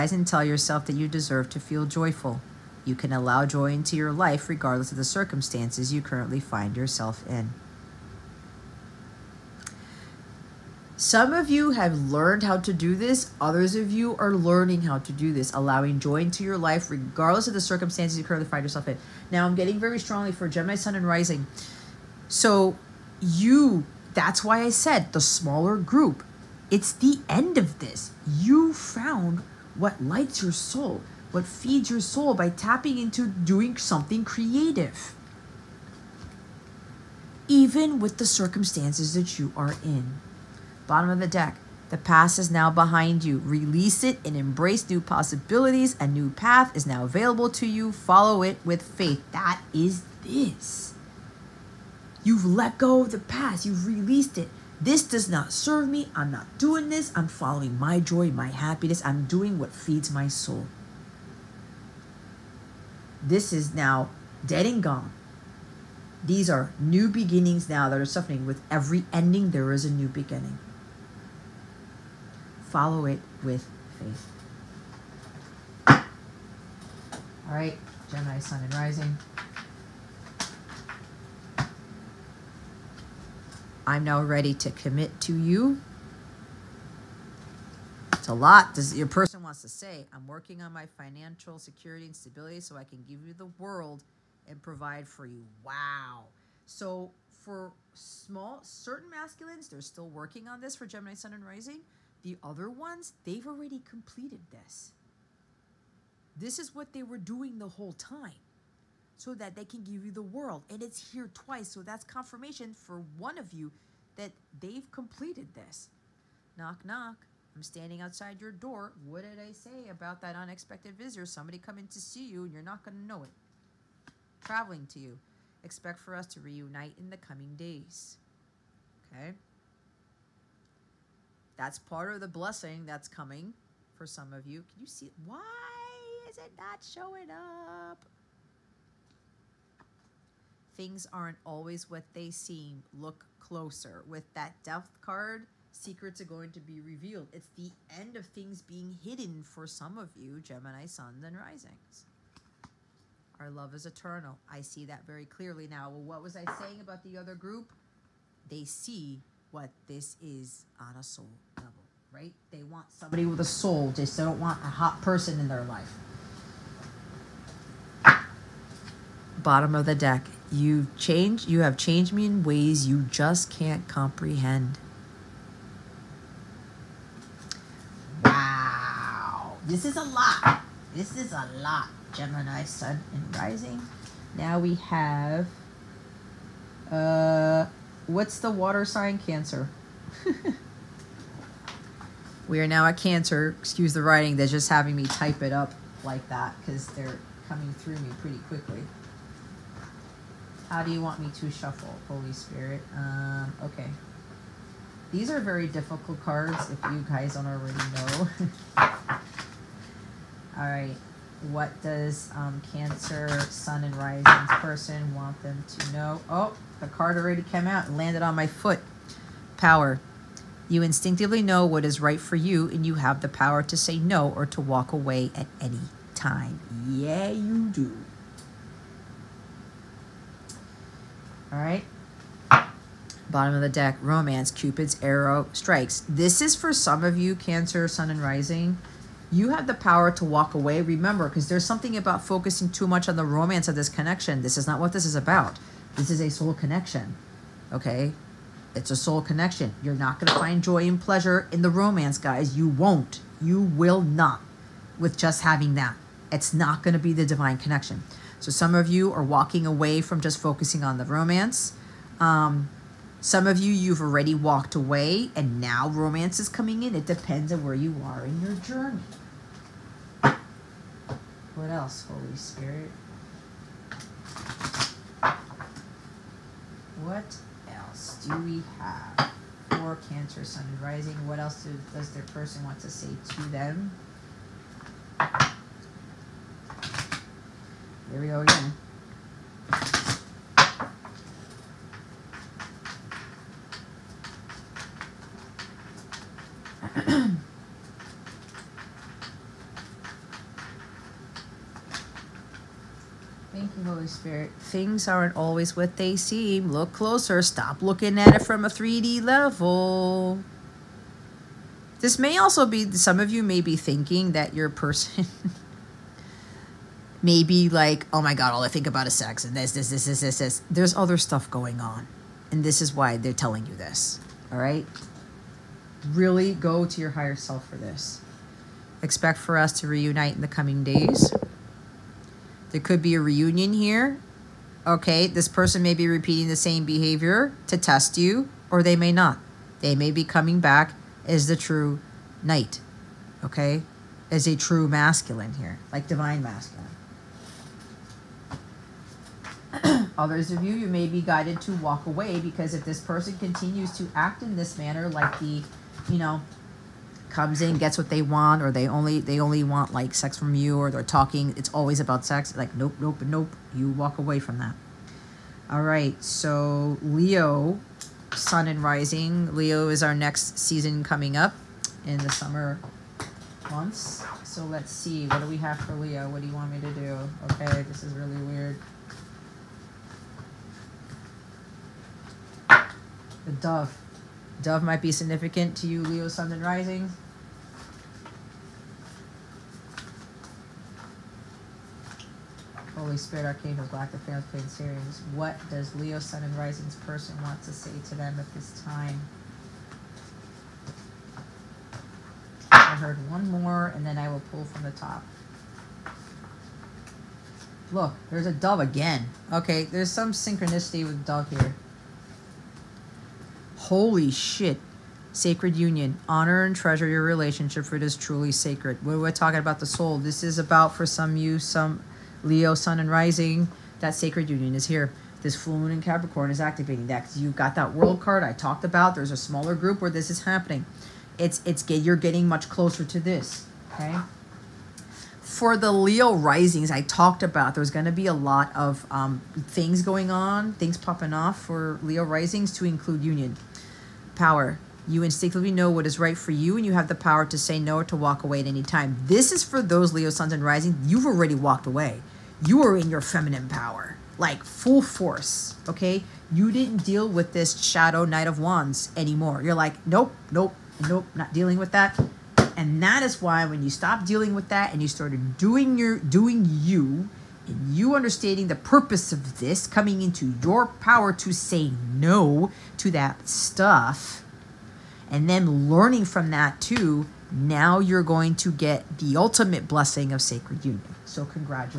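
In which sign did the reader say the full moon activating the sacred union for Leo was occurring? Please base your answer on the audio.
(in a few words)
Capricorn.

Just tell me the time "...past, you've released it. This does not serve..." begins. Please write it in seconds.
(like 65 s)
53 s.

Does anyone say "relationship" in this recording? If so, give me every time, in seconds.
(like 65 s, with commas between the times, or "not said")
417 s.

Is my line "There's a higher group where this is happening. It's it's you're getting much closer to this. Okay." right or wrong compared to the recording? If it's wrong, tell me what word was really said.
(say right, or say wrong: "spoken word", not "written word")
wrong: "smaller", not "higher".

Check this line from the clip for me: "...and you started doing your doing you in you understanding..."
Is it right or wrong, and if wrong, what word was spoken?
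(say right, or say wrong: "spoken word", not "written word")
right.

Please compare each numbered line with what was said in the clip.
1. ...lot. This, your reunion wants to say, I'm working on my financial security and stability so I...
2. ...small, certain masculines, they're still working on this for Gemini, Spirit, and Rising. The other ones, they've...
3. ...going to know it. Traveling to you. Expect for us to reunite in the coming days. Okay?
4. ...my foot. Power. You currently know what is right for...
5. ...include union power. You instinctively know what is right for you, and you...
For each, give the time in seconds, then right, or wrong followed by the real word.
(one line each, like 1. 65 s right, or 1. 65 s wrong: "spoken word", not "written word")
1. 88 s wrong: "person", not "reunion"
2. 97 s wrong: "Sun", not "Spirit"
3. 122 s right
4. 218 s wrong: "instinctively", not "currently"
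5. 442 s right.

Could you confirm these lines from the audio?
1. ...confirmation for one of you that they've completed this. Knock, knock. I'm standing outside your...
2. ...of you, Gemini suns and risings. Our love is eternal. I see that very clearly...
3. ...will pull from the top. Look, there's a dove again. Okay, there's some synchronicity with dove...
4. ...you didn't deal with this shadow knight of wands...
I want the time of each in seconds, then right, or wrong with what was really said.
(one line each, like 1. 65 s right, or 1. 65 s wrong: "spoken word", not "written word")
1. 112 s right
2. 149 s right
3. 404 s right
4. 456 s right.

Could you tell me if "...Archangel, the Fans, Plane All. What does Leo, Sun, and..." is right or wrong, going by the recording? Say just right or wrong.
wrong.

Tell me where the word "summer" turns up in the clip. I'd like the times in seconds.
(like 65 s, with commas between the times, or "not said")
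372 s.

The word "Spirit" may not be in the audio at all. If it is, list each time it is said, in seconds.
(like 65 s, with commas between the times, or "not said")
202 s, 272 s, 304 s, 393 s.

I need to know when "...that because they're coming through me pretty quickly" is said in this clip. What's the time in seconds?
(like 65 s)
196 s.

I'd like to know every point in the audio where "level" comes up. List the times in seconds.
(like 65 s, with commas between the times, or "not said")
161 s, 309 s.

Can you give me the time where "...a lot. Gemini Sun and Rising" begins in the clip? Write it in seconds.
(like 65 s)
181 s.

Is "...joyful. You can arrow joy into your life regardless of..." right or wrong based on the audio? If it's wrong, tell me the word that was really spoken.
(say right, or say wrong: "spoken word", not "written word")
wrong: "allow", not "arrow".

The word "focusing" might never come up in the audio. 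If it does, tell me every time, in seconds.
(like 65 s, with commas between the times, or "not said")
242 s, 260 s.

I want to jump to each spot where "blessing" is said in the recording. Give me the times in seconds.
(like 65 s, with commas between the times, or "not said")
132 s, 479 s.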